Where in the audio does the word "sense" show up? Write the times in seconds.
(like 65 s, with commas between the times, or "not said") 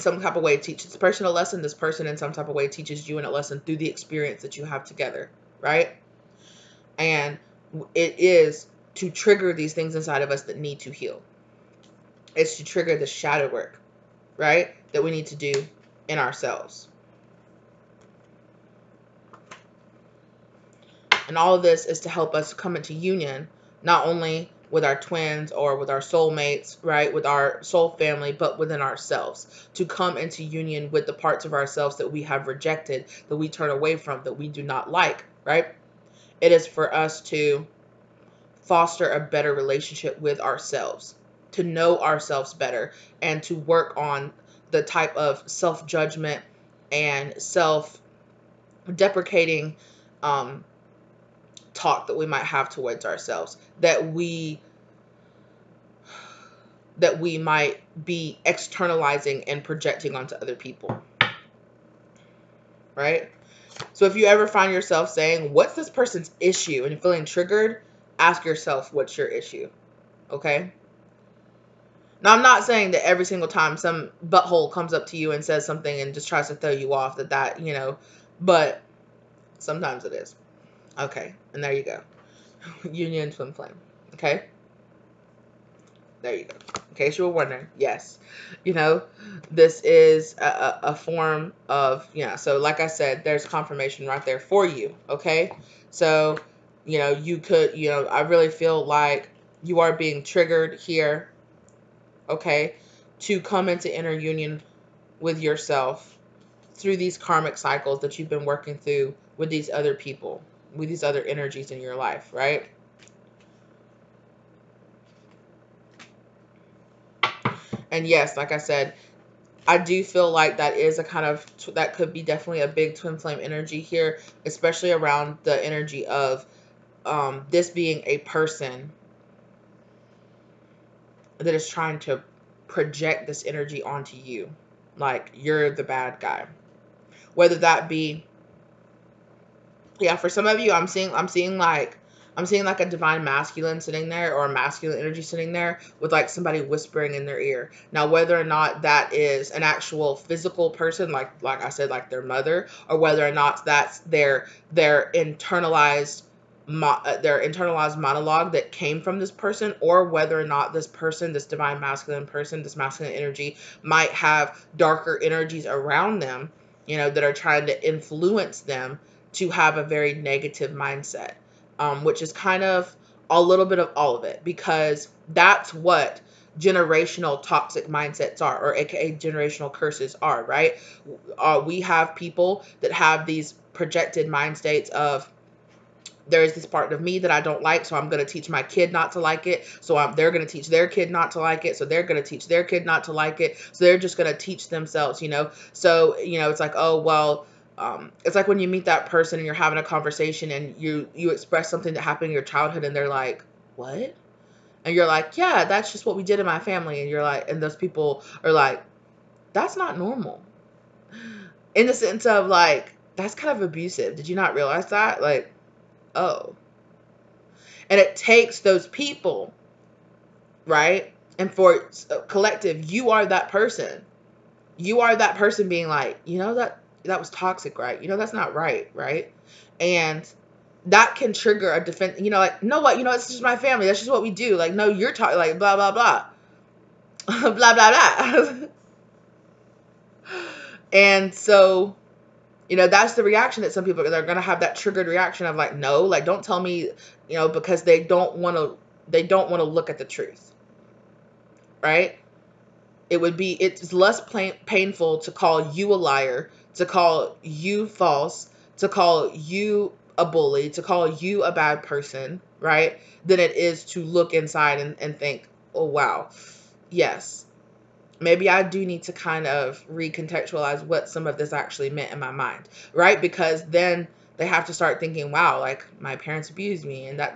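211 s.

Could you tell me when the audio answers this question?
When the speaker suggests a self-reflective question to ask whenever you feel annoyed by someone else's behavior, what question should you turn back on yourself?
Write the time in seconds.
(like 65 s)
68 s.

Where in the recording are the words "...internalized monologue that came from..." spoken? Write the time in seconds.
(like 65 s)
157 s.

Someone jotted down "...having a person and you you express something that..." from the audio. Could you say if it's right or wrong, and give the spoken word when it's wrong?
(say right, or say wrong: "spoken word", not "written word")
wrong: "conversation", not "person".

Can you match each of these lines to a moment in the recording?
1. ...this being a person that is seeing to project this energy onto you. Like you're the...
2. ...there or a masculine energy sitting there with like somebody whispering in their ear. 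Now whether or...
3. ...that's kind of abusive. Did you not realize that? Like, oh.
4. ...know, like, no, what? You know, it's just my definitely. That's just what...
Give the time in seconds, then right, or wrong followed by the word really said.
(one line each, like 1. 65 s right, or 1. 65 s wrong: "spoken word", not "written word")
1. 127 s wrong: "trying", not "seeing"
2. 144 s right
3. 213 s right
4. 232 s wrong: "family", not "definitely".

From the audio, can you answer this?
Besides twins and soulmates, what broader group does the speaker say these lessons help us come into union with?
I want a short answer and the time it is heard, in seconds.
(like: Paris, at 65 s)
Soul family, at 27 s.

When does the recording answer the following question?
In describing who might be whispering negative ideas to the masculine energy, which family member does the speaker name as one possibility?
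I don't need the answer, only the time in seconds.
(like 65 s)
152 s.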